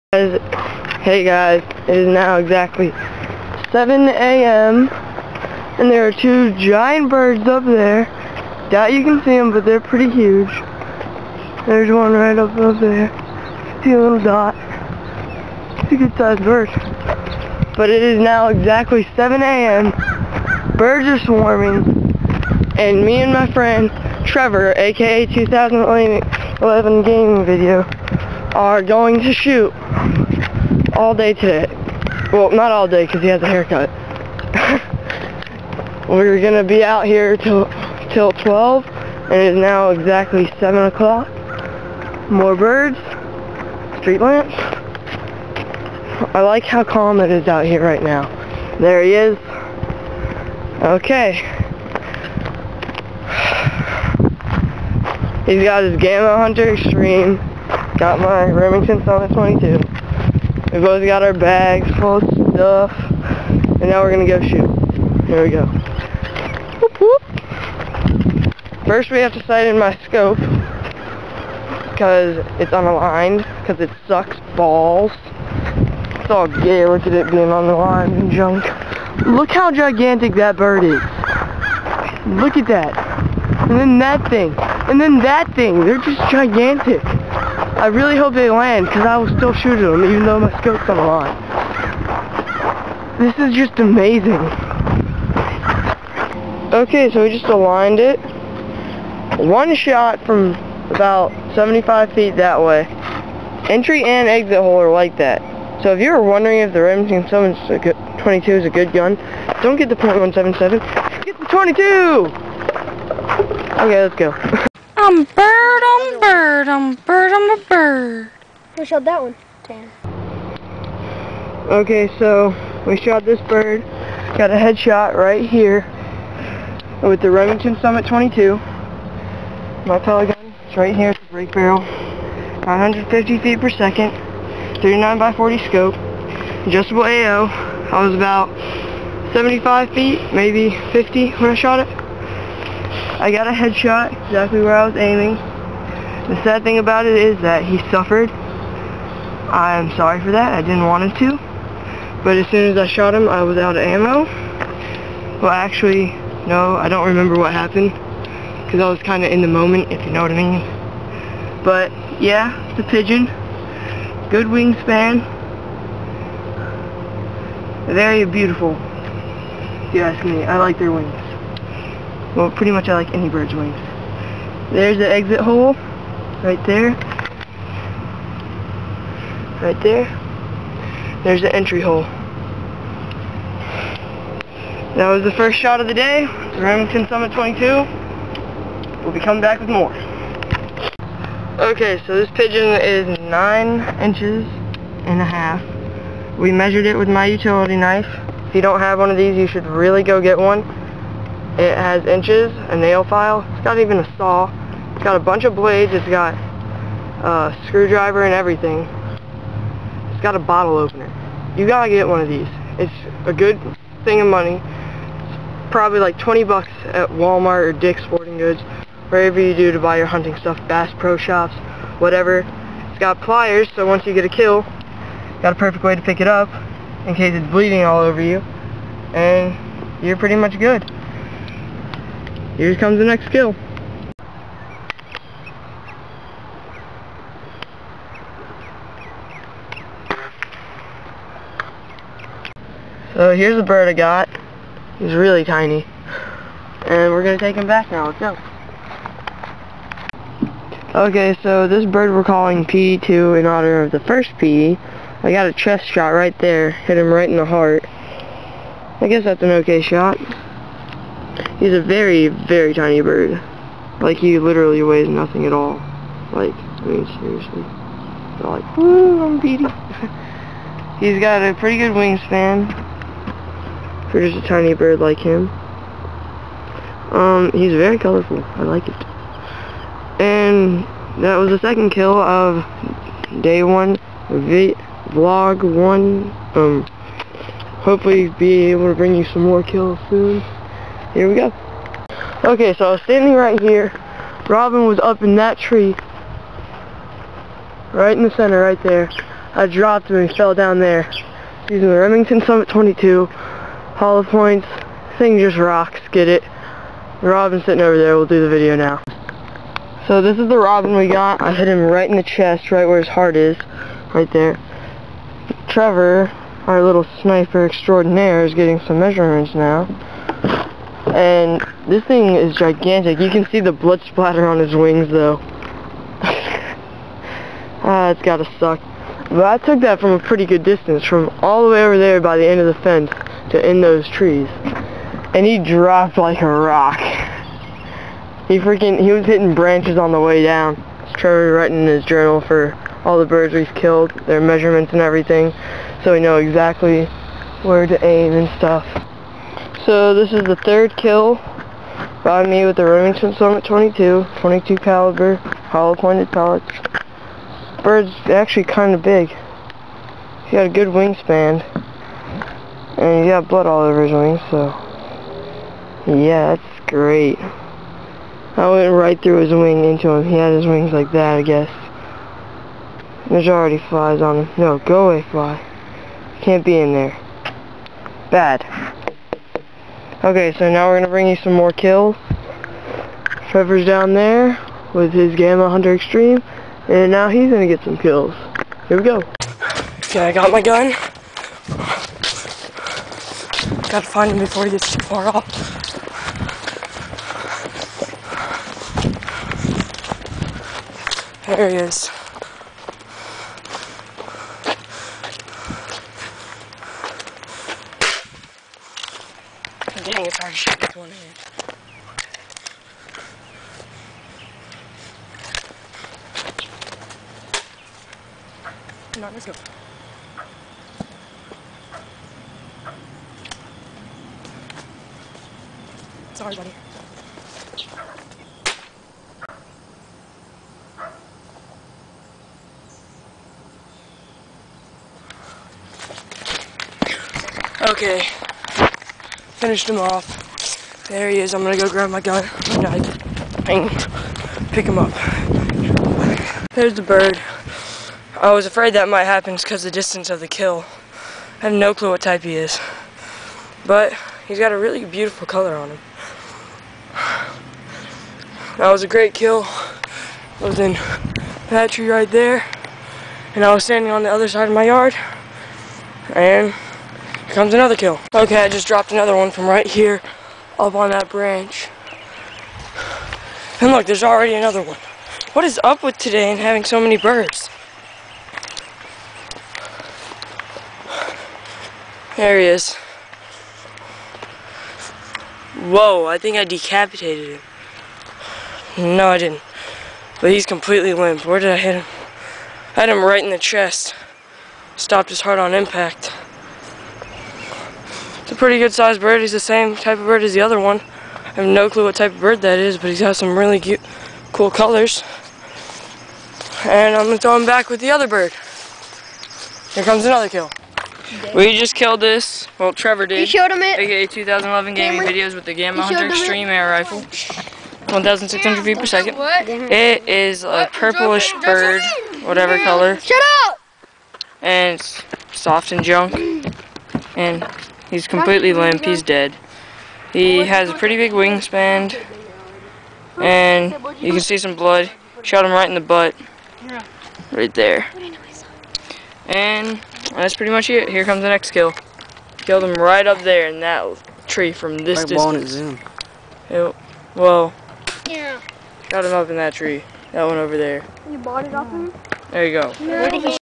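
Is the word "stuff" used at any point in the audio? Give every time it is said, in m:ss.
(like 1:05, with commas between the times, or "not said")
1:02, 3:40, 5:48.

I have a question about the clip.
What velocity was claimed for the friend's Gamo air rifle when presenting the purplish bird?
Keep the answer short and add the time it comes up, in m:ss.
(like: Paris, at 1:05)
1,600 feet per second, at 8:38.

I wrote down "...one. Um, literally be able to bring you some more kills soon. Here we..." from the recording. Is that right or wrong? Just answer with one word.
wrong.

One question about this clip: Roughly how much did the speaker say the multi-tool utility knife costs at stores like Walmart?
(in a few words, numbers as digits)
20 bucks.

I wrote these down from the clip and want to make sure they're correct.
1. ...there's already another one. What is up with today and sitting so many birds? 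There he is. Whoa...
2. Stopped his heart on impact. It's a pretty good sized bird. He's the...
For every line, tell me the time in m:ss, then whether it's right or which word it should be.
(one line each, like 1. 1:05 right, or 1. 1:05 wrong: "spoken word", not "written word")
1. 7:54 wrong: "having", not "sitting"
2. 8:14 right.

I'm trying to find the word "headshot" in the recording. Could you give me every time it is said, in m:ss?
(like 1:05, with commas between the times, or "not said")
2:04, 2:23.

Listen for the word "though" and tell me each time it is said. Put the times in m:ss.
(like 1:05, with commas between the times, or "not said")
1:30, 5:25.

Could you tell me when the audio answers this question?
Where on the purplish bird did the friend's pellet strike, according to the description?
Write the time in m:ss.
8:56.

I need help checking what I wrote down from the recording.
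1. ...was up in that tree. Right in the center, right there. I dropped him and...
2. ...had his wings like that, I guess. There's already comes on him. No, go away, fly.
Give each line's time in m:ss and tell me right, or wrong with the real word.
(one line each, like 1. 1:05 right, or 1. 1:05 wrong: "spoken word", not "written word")
1. 4:54 right
2. 6:10 wrong: "flies", not "comes".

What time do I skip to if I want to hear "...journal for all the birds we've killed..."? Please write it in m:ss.
5:42.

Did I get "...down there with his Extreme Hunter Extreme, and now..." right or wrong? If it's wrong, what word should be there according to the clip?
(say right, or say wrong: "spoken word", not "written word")
wrong: "Gamo", not "Extreme".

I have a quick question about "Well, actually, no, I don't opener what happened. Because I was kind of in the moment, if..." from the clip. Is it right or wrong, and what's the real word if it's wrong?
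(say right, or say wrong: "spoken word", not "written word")
wrong: "remember", not "opener".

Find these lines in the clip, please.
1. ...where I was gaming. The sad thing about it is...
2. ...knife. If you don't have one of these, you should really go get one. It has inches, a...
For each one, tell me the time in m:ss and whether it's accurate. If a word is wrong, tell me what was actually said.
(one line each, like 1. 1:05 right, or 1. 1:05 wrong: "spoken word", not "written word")
1. 2:24 wrong: "aiming", not "gaming"
2. 3:17 right.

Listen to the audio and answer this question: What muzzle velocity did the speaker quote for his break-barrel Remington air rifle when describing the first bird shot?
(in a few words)
950 feet per second.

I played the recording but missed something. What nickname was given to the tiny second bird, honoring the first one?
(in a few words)
P2.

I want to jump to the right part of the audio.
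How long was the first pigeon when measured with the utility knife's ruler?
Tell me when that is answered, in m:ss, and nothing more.
3:13.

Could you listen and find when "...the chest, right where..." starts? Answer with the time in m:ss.
5:12.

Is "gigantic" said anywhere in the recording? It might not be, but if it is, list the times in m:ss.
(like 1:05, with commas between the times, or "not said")
1:19, 1:26, 5:22.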